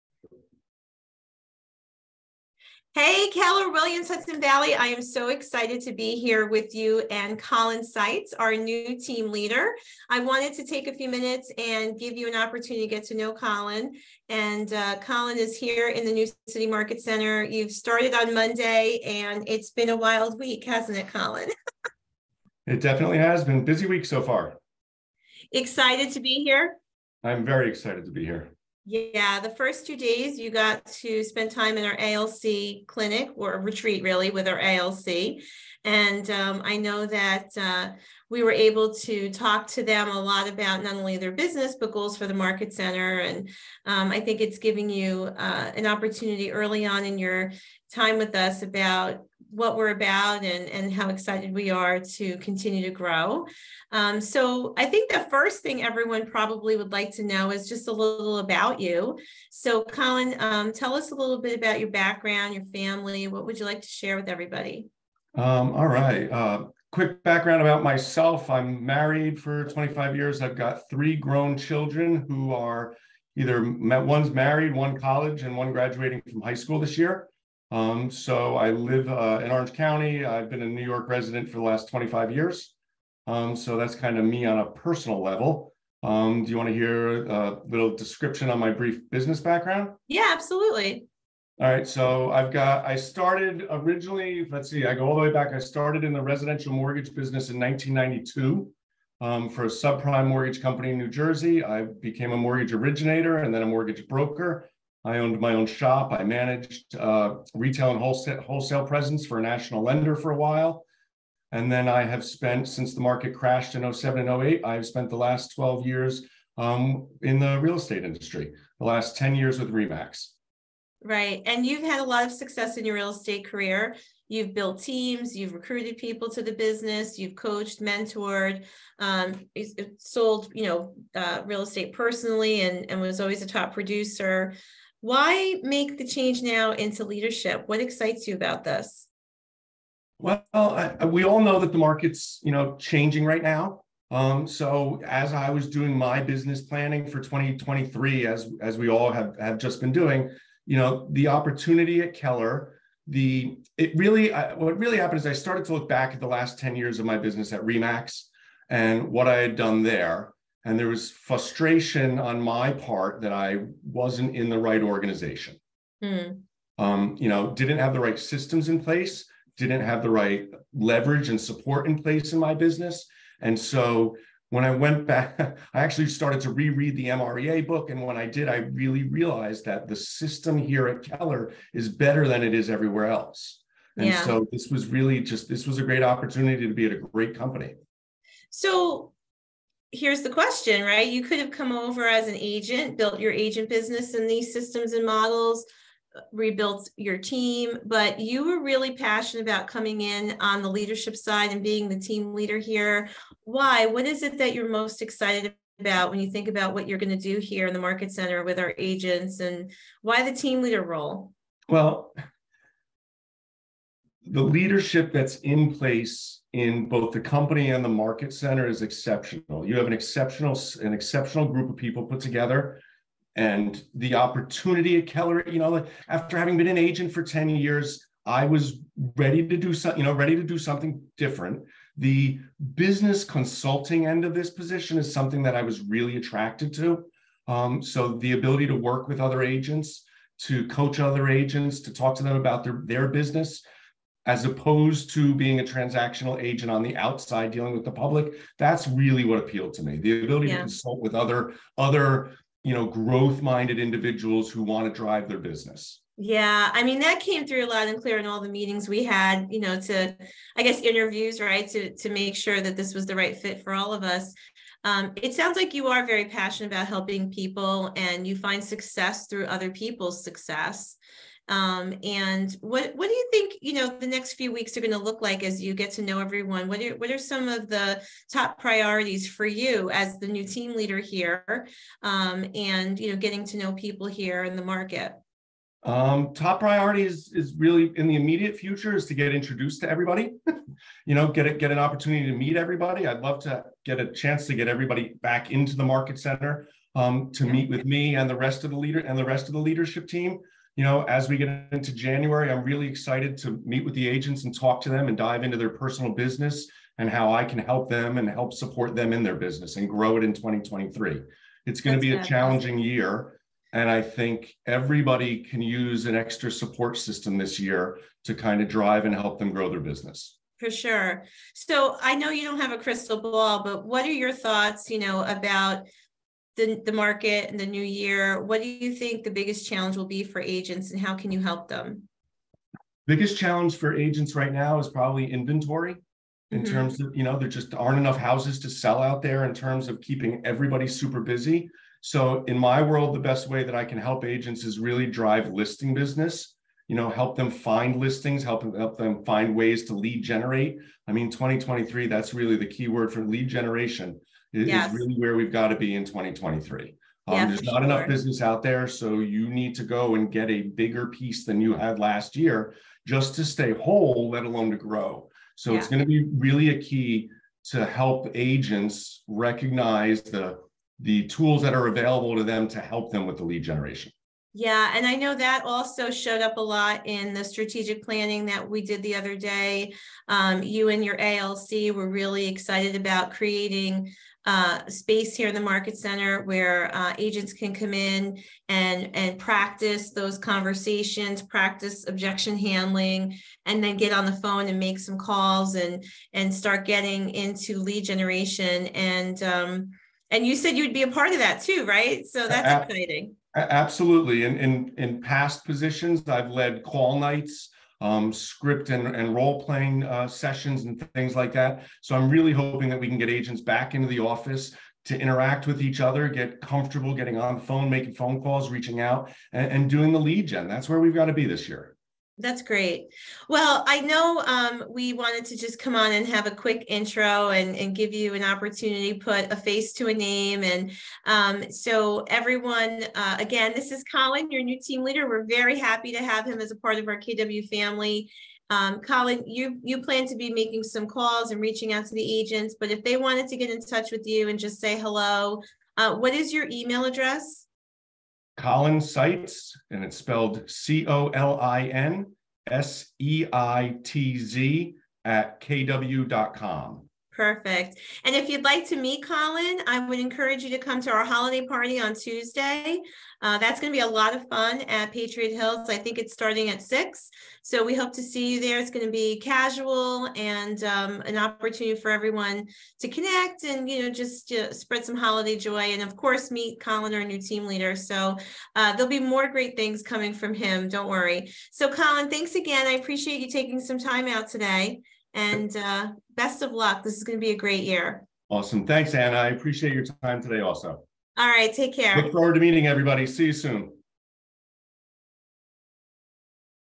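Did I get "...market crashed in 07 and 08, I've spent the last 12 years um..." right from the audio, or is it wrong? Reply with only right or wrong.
right.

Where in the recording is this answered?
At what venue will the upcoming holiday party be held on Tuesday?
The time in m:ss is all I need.
7:45.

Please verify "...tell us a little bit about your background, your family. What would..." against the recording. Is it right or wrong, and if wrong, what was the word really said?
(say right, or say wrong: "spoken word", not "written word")
right.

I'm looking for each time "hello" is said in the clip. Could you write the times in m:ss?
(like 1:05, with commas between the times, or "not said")
7:24.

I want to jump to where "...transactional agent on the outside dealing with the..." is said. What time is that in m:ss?
4:05.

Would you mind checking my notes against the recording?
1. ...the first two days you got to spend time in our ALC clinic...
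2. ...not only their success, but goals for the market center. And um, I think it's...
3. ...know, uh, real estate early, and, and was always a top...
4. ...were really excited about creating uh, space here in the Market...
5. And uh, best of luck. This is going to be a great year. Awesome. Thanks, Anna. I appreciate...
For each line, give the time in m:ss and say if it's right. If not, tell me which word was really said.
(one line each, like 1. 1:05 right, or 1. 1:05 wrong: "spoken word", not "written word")
1. 0:29 right
2. 0:40 wrong: "business", not "success"
3. 2:10 wrong: "personally", not "early"
4. 6:21 right
5. 8:05 right.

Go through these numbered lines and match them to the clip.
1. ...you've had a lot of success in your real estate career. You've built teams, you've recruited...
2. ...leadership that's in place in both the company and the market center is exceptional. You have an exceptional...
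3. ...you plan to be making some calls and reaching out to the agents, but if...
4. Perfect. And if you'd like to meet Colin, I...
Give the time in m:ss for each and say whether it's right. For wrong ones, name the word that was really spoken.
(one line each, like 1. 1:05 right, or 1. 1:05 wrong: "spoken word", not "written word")
1. 2:01 right
2. 3:34 right
3. 7:19 right
4. 7:37 right.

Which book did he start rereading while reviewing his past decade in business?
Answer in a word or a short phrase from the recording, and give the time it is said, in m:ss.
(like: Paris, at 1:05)
MREA, at 2:57.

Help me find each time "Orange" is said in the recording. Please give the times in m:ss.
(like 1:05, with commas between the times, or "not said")
1:19.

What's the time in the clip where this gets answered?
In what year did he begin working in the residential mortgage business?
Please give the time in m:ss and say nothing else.
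1:37.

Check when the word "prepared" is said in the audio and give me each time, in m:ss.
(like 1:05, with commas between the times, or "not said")
not said.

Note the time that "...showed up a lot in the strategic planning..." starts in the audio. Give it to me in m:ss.
6:16.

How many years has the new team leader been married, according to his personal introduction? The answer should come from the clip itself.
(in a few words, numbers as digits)
25.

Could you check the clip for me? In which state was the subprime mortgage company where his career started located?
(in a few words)
New Jersey.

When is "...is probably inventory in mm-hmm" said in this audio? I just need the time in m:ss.
5:34.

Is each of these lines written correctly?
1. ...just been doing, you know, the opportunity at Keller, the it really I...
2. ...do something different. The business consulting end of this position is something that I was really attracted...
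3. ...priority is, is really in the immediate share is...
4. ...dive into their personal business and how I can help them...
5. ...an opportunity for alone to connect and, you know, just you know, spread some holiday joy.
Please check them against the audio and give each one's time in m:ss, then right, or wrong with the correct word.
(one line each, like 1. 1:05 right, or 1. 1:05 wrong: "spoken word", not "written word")
1. 2:29 right
2. 3:50 right
3. 4:46 wrong: "future", not "share"
4. 5:05 right
5. 7:51 wrong: "everyone", not "alone".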